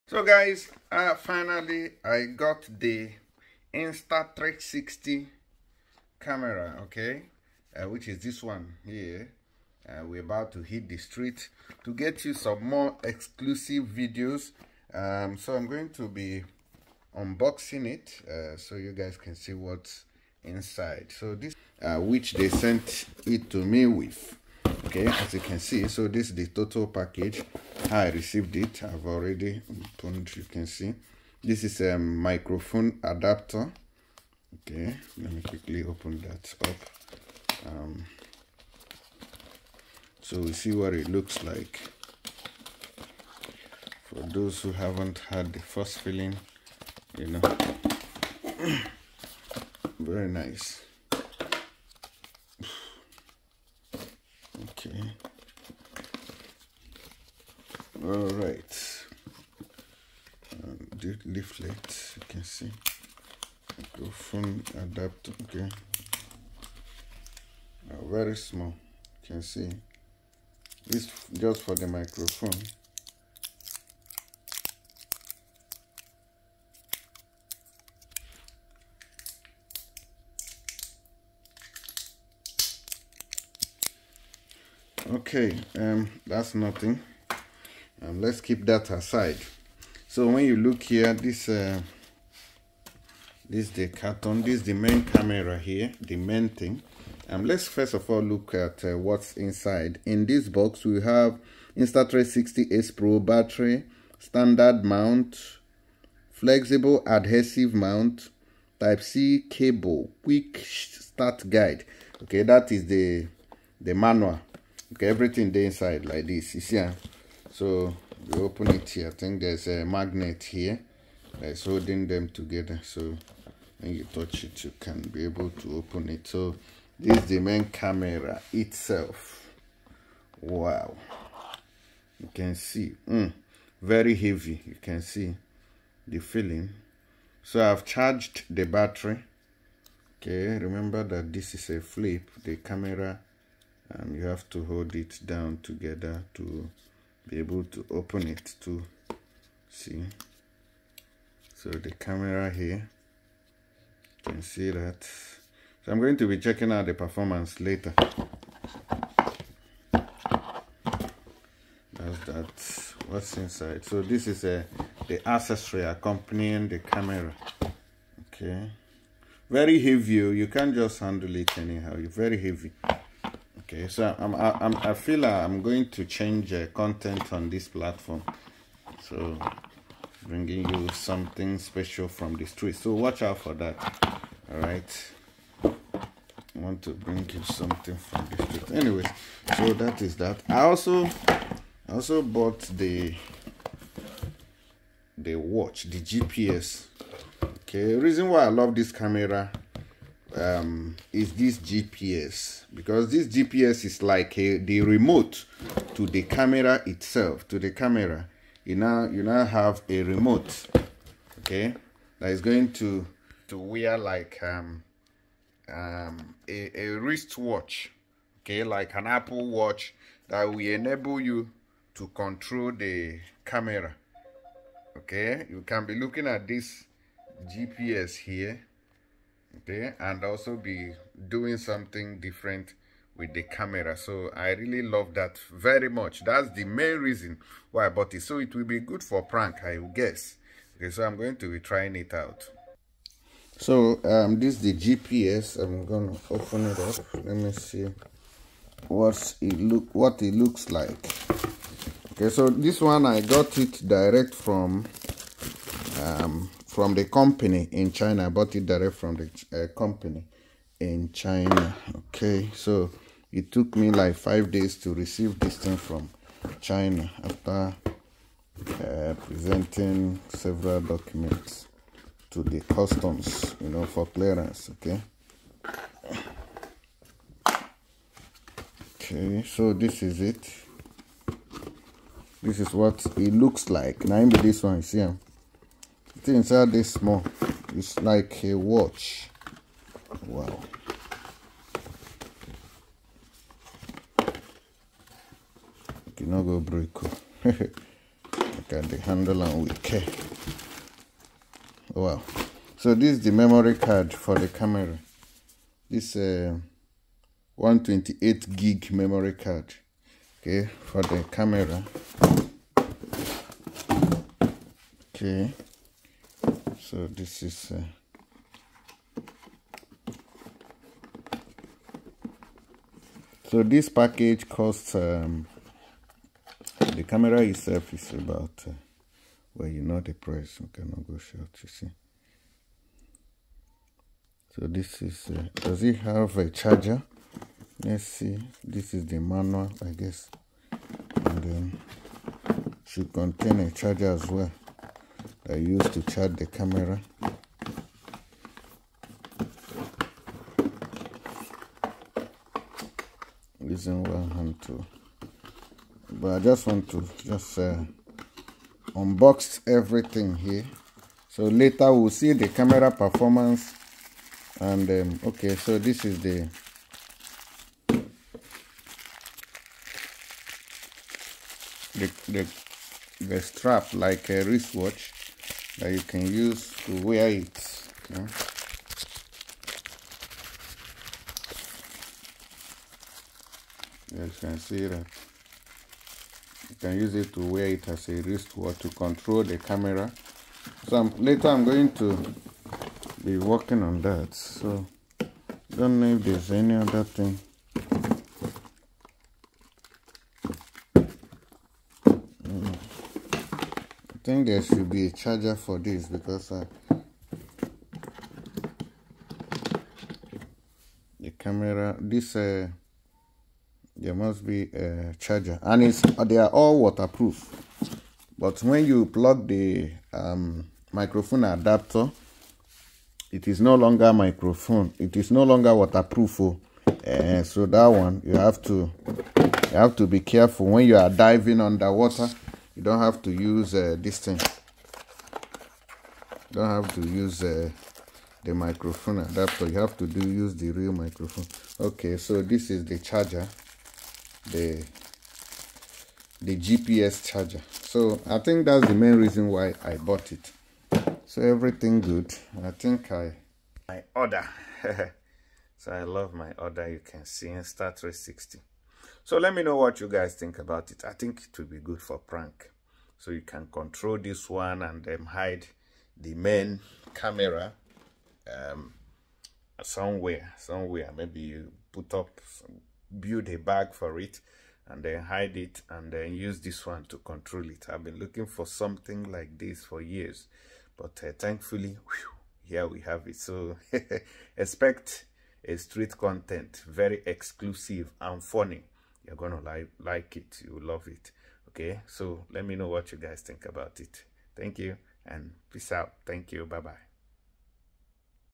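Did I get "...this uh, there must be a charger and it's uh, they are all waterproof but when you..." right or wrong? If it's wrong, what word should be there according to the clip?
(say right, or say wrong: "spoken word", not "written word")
right.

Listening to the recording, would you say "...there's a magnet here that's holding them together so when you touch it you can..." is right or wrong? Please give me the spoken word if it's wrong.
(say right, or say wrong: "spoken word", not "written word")
right.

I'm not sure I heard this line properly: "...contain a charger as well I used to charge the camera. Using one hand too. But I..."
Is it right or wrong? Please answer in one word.
right.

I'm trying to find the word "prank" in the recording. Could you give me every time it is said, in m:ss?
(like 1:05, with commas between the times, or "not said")
3:59, 7:42.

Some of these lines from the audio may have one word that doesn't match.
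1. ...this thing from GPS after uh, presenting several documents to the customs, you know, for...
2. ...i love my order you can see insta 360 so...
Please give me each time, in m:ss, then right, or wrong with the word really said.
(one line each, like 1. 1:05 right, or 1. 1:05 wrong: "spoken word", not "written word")
1. 4:25 wrong: "China", not "GPS"
2. 7:35 right.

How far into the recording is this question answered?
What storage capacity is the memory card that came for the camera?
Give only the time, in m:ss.
5:07.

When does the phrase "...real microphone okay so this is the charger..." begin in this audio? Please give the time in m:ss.
7:20.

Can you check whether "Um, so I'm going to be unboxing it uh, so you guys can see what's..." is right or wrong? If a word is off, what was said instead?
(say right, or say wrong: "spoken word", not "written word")
right.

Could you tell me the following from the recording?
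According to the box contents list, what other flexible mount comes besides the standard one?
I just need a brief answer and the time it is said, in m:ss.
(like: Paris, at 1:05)
adhesive mount, at 1:47.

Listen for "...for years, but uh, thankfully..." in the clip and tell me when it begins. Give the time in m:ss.
7:59.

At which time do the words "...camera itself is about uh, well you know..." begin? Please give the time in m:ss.
5:27.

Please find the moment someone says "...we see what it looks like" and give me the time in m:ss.
0:40.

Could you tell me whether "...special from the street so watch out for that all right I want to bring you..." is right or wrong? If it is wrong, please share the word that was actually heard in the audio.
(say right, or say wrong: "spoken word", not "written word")
right.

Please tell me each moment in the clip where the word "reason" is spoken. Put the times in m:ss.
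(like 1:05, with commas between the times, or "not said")
3:17, 3:56, 7:29.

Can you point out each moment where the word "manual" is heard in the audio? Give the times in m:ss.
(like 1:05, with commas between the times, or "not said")
1:53, 5:39.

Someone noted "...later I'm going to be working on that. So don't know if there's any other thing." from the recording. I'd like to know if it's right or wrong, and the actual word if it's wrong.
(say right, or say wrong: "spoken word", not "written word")
right.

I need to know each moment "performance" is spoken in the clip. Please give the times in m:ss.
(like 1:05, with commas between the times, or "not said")
2:36, 6:02.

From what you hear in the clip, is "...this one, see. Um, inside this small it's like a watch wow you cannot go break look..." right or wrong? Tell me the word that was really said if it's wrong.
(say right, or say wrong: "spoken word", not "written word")
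right.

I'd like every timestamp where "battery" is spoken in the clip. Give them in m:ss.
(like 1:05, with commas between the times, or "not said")
1:43, 2:18.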